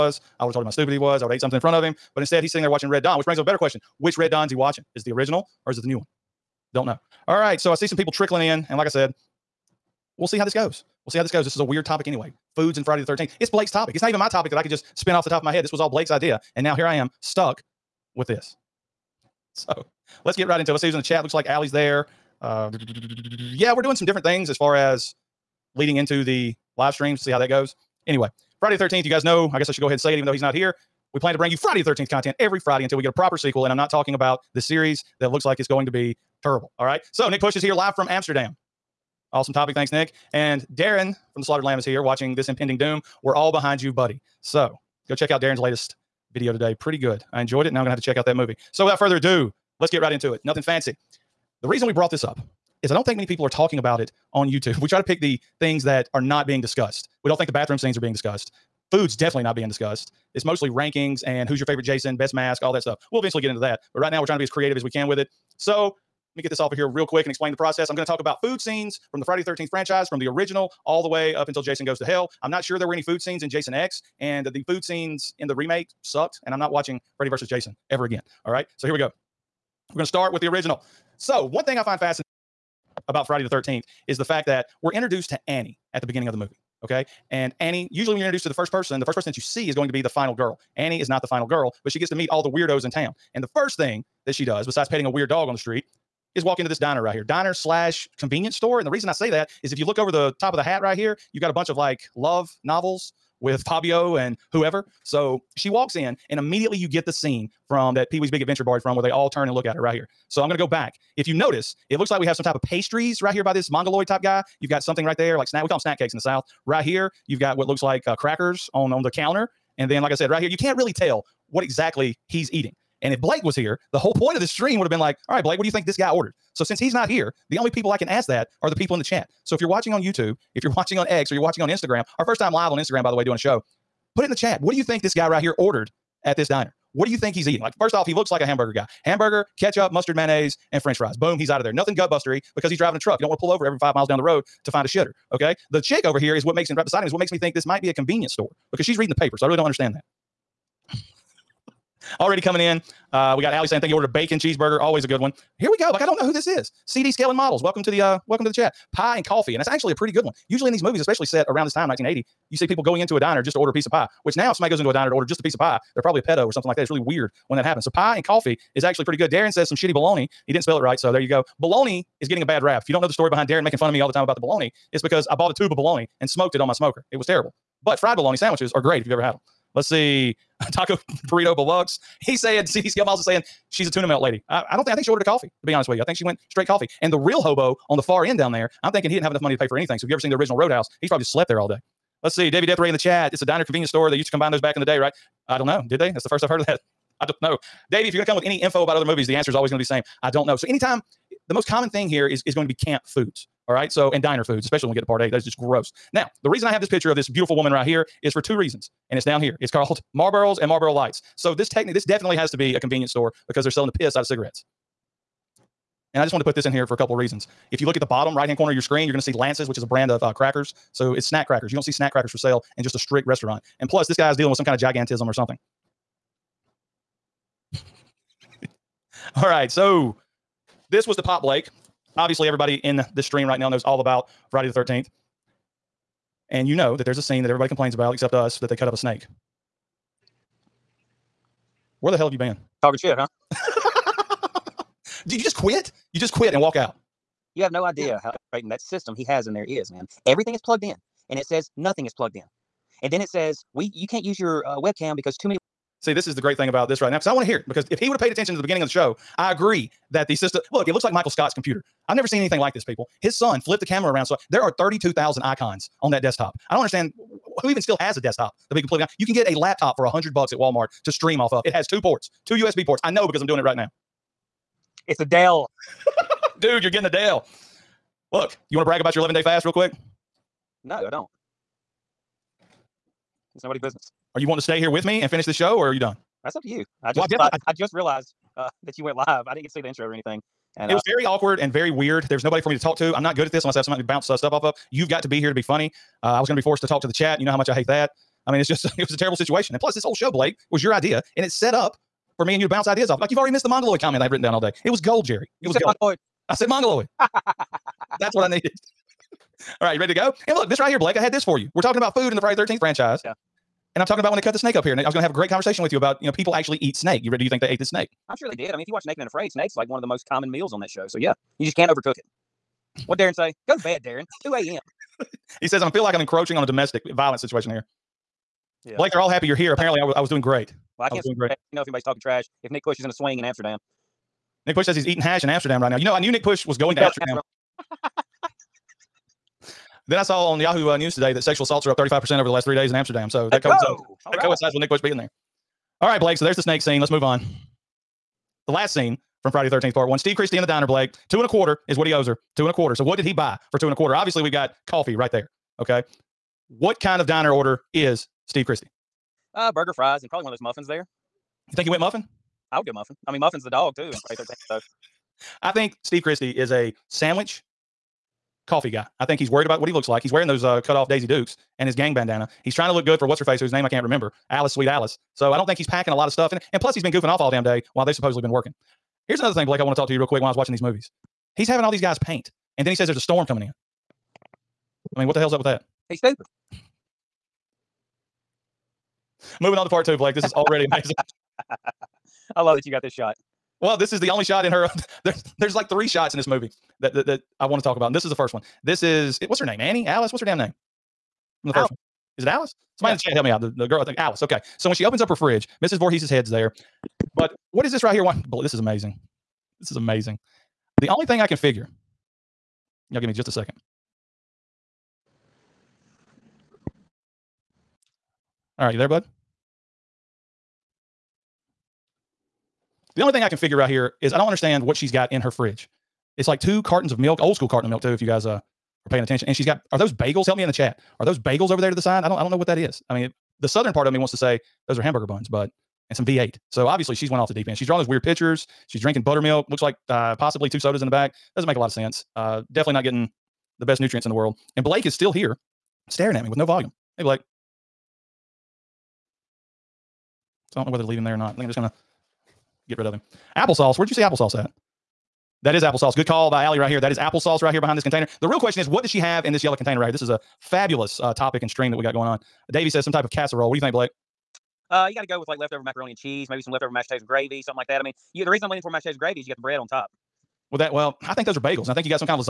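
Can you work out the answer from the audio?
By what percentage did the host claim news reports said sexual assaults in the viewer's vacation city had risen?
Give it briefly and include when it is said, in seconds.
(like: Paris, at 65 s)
35%, at 341 s.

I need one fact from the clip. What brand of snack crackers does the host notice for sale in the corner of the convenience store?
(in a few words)
Lance's.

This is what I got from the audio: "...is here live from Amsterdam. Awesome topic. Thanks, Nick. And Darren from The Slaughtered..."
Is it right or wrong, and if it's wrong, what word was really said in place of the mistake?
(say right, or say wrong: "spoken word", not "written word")
right.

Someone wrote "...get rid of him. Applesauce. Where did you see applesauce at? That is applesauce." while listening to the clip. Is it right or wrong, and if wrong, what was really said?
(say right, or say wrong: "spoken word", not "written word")
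right.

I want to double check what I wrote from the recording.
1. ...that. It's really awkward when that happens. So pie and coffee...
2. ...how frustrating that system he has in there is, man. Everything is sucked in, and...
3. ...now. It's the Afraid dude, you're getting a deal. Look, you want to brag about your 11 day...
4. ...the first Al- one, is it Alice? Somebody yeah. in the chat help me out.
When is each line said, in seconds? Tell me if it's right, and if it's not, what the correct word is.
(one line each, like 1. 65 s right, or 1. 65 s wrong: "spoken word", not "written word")
1. 166 s wrong: "weird", not "awkward"
2. 248 s wrong: "plugged", not "sucked"
3. 273 s wrong: "Dell", not "Afraid"
4. 401 s right.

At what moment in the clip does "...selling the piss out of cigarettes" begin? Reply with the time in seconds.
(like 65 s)
213 s.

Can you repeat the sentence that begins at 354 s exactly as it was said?
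Obviously, we've got coffee right there.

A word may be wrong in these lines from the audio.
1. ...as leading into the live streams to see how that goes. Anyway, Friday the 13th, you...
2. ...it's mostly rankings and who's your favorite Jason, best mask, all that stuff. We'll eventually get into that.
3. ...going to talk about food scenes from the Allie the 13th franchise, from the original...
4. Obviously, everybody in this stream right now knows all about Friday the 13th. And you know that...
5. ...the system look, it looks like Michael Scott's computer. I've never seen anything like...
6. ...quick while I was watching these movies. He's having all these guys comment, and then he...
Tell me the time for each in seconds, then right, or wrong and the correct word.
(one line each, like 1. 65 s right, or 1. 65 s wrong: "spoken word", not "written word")
1. 24 s right
2. 60 s right
3. 67 s wrong: "Friday", not "Allie"
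4. 232 s right
5. 260 s right
6. 380 s wrong: "paint", not "comment".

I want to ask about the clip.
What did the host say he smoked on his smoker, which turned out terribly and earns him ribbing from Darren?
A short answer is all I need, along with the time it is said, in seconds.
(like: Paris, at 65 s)
A tube of baloney, at 175 s.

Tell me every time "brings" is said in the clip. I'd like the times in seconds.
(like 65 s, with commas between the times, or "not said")
3 s, 31 s.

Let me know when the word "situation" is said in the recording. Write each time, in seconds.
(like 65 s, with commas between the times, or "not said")
299 s, 327 s.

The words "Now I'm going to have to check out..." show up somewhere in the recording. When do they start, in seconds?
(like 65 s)
47 s.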